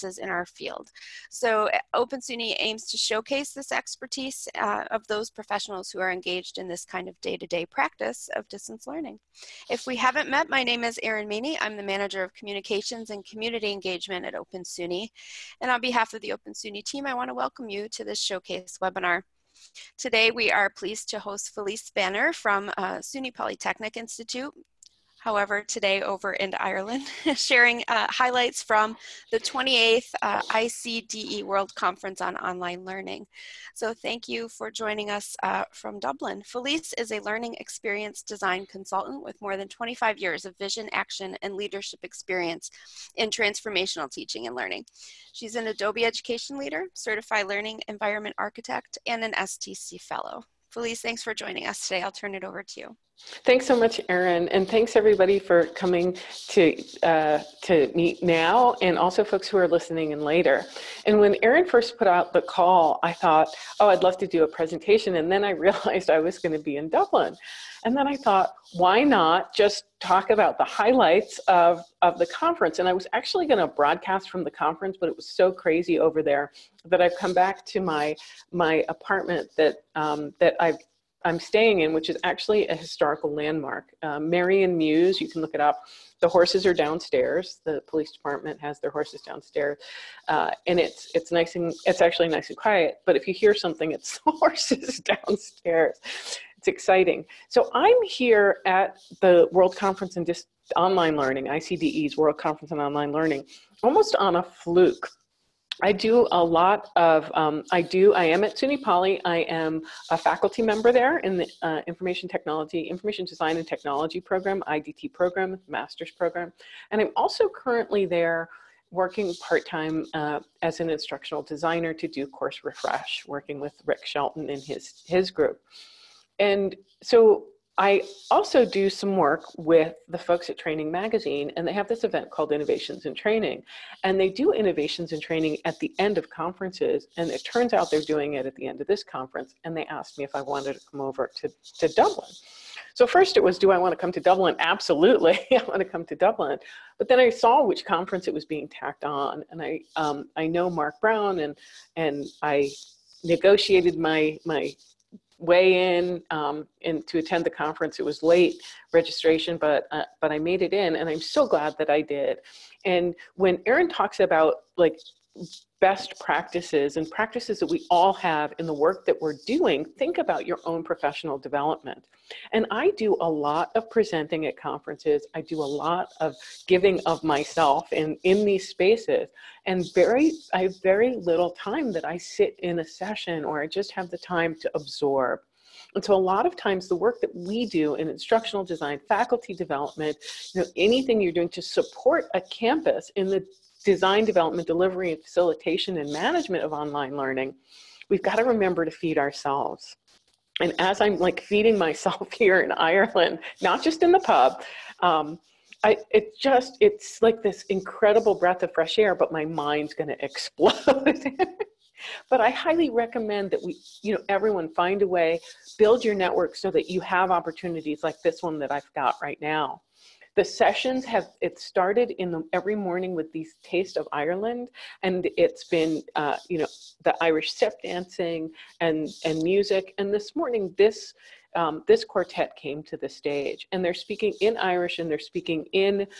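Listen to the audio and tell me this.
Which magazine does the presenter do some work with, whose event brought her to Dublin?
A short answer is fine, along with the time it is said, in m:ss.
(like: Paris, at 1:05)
Training Magazine, at 2:10.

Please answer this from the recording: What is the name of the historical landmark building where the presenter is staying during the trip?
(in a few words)
Marion Muse.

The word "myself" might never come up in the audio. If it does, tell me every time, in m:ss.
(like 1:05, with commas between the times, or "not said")
2:57, 3:21.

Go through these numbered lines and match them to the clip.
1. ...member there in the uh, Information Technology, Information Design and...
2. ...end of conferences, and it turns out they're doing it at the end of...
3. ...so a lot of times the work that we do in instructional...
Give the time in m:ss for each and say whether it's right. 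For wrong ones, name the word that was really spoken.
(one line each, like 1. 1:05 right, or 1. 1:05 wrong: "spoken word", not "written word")
1. 1:50 right
2. 2:16 right
3. 3:06 right.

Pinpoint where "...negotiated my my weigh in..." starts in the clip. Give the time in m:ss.
2:33.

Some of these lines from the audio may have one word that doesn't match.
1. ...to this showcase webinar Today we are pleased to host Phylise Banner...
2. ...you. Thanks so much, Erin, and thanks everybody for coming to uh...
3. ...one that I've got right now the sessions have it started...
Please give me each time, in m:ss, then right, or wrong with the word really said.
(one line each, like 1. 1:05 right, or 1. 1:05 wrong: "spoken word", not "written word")
1. 0:17 right
2. 0:52 right
3. 3:38 right.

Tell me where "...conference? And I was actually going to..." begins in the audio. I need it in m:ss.
1:12.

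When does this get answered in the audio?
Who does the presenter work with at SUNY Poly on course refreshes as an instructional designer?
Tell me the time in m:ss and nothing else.
2:03.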